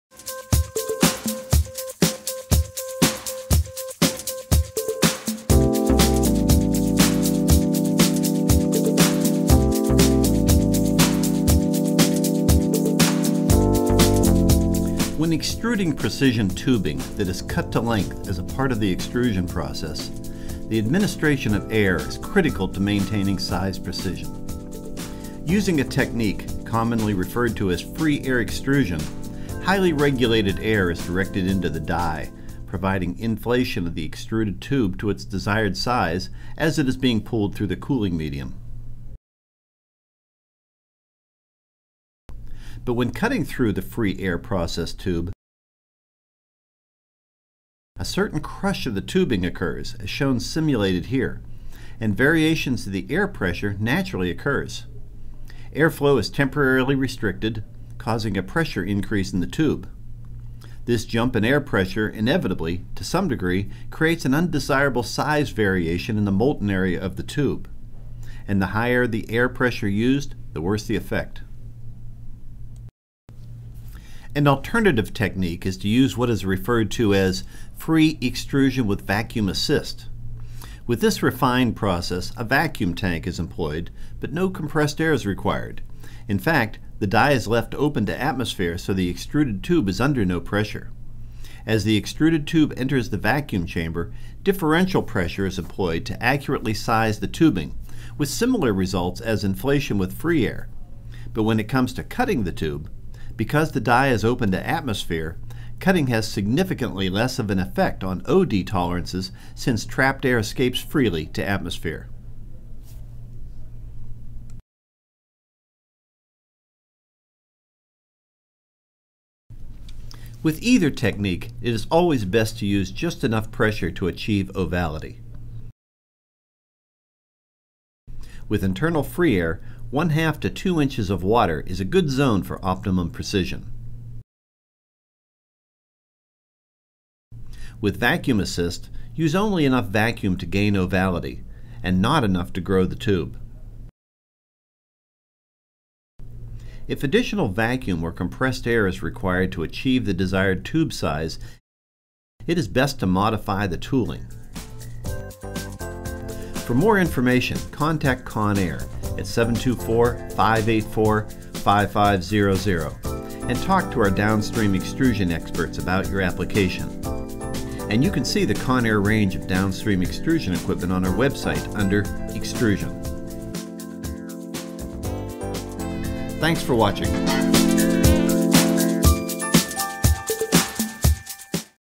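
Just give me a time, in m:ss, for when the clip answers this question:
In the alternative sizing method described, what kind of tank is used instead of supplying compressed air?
1:22.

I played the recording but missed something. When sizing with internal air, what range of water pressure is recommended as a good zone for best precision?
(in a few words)
1/2 to 2 inches of water.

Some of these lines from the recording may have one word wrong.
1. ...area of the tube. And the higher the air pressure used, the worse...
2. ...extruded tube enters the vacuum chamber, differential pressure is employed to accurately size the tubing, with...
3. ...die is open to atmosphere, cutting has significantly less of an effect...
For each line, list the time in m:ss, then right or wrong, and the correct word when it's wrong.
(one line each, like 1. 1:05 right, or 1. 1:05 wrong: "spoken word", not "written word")
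1. 1:06 right
2. 1:31 right
3. 1:43 right.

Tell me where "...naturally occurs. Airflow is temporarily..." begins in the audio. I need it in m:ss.
0:53.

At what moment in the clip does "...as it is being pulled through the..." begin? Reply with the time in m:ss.
0:36.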